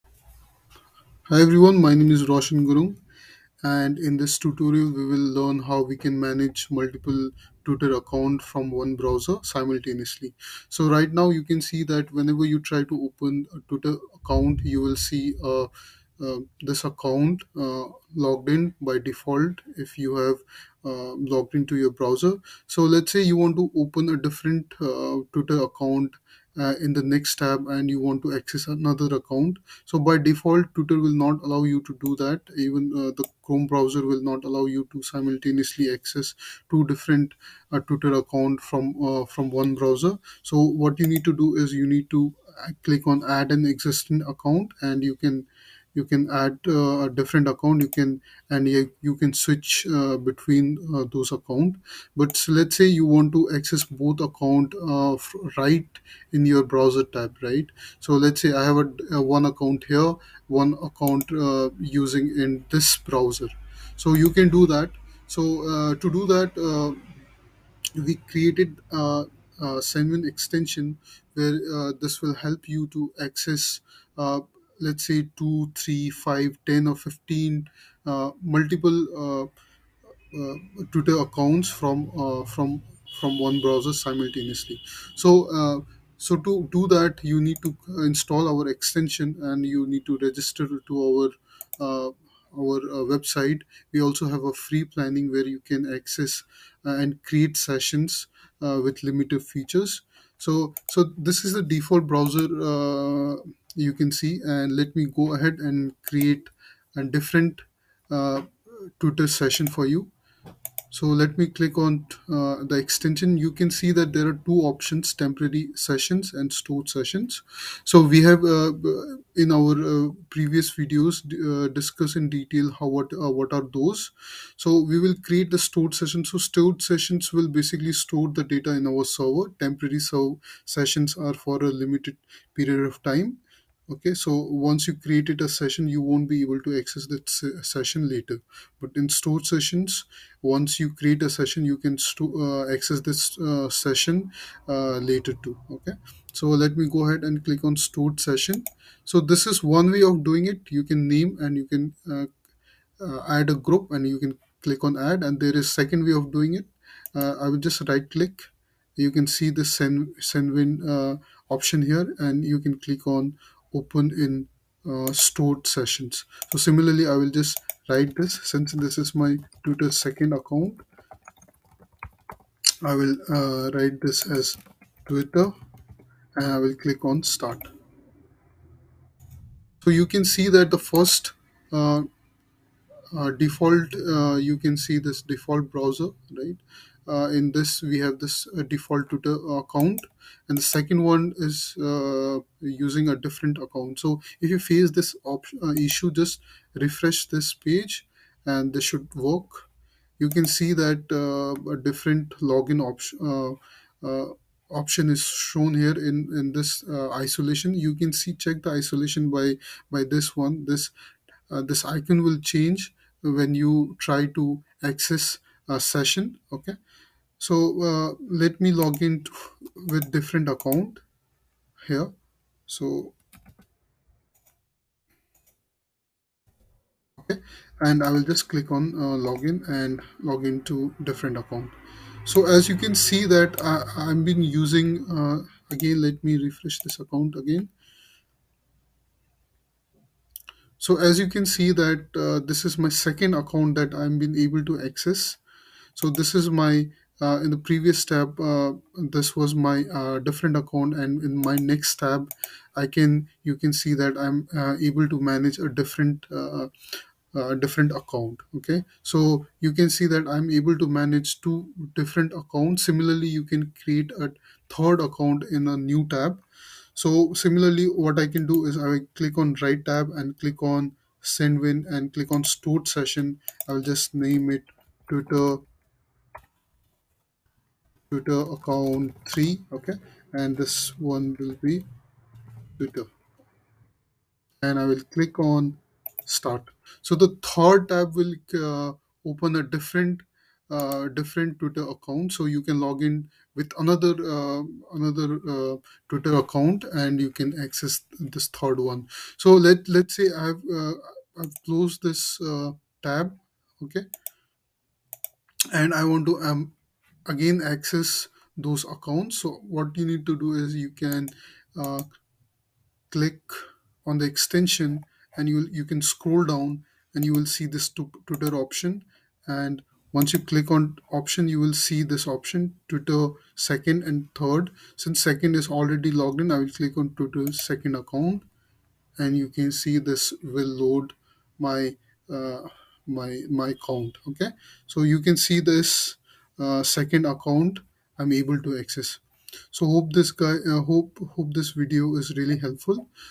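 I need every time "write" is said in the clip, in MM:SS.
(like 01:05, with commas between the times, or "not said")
02:47, 02:53.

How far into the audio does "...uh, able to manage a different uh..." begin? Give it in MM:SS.
04:14.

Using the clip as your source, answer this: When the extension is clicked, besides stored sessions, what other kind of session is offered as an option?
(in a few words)
temporary sessions.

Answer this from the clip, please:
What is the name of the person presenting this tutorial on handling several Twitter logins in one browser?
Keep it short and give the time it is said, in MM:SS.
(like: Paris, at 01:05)
Roshan Gurung, at 00:02.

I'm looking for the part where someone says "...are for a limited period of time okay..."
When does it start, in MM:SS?
02:11.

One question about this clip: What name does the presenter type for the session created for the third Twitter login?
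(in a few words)
Twitter account 3.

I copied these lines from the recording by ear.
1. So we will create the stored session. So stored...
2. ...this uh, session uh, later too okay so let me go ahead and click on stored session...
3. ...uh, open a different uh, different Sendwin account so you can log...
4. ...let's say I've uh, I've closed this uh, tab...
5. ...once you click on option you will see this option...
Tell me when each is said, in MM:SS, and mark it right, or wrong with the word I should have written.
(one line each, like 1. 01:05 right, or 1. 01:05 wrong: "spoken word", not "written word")
1. 02:04 right
2. 02:23 right
3. 04:48 wrong: "Twitter", not "Sendwin"
4. 04:59 right
5. 05:20 right.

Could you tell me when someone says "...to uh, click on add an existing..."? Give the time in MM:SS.
00:42.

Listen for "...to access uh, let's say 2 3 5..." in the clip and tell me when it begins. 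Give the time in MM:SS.
01:12.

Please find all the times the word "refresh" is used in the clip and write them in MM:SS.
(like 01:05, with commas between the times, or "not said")
03:16, 03:56.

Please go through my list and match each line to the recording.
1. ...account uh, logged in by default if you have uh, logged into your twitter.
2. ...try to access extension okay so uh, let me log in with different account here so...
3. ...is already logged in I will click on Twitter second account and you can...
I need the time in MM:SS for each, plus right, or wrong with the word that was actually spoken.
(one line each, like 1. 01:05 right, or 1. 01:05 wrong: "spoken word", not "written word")
1. 00:16 wrong: "browser", not "twitter"
2. 03:33 wrong: "session", not "extension"
3. 05:25 right.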